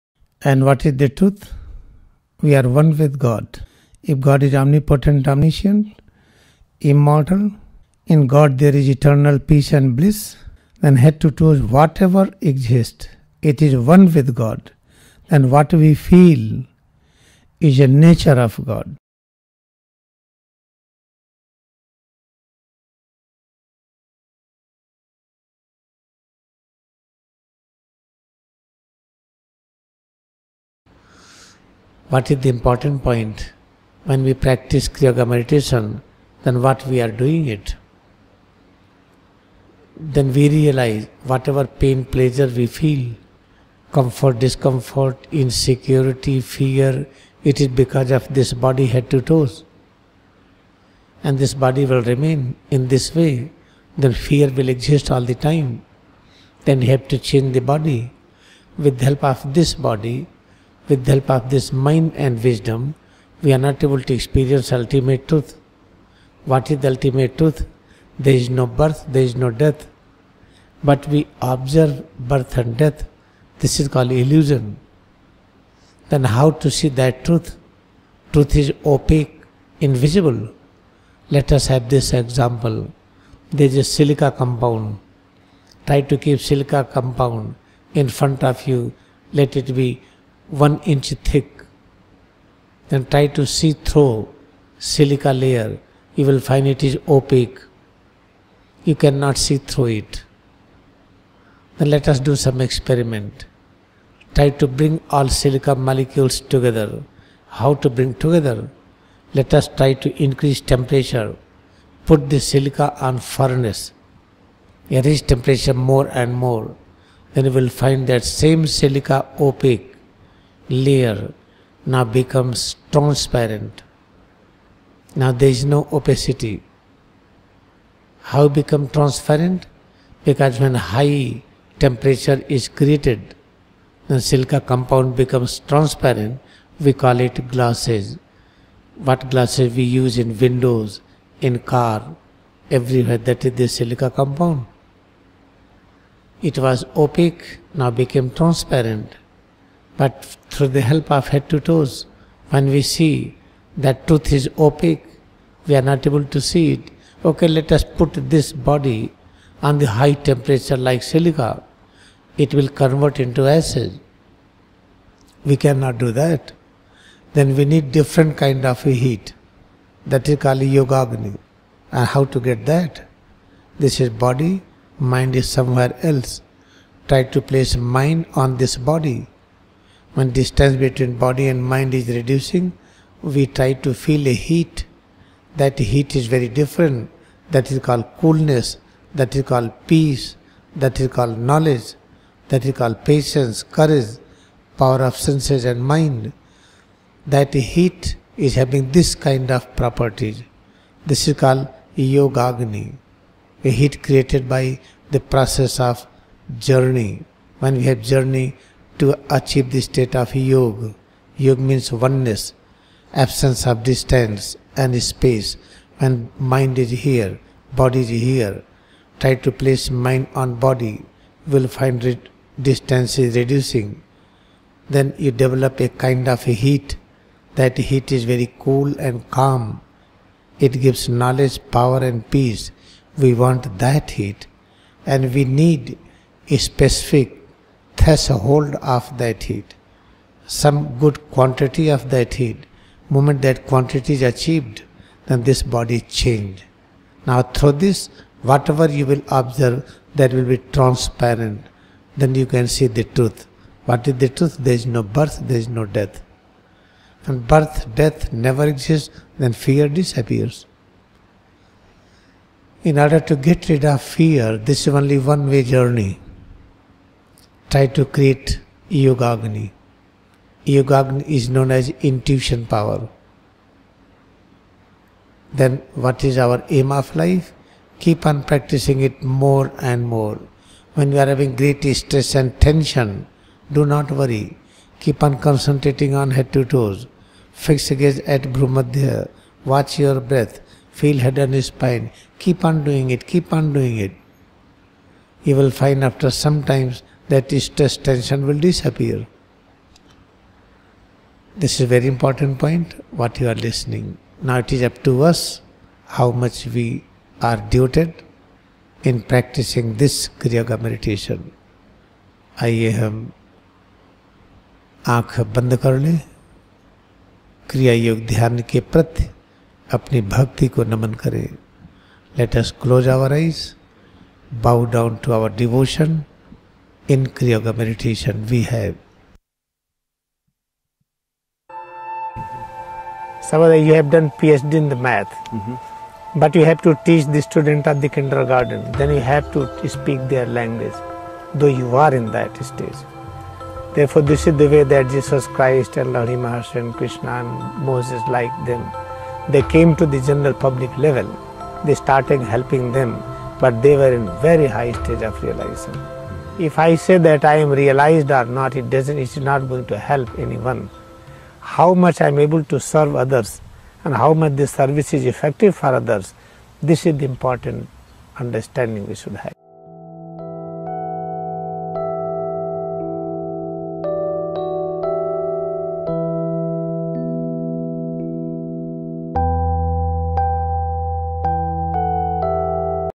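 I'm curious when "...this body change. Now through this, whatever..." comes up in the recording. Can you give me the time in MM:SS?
04:05.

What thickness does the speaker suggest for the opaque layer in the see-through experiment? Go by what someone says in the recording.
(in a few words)
1 inch.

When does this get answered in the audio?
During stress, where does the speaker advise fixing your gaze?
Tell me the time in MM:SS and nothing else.
04:48.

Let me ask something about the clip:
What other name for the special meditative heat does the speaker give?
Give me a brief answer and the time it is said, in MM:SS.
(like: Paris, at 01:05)
intuition power, at 04:32.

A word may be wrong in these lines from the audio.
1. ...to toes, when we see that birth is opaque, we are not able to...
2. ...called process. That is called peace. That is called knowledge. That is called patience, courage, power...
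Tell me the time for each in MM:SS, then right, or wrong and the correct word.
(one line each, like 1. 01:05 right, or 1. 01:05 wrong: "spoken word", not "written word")
1. 02:31 wrong: "truth", not "birth"
2. 03:07 wrong: "coolness", not "process".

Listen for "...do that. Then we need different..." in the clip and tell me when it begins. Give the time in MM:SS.
02:45.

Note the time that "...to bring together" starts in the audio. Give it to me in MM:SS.
01:47.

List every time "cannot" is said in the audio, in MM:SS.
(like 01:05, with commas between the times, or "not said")
01:38, 02:45.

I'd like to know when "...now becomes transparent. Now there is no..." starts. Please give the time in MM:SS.
02:01.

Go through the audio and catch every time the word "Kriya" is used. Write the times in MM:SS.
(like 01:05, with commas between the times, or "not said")
00:34, 05:10, 05:27.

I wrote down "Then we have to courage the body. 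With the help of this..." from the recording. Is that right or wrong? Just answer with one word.
wrong.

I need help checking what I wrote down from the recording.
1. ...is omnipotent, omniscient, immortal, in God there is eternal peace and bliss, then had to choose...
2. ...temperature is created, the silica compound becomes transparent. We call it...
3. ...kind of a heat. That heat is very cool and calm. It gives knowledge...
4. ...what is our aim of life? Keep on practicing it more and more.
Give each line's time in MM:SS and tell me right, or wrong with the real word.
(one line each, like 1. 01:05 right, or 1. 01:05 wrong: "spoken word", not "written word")
1. 00:04 right
2. 02:11 right
3. 03:45 right
4. 04:35 right.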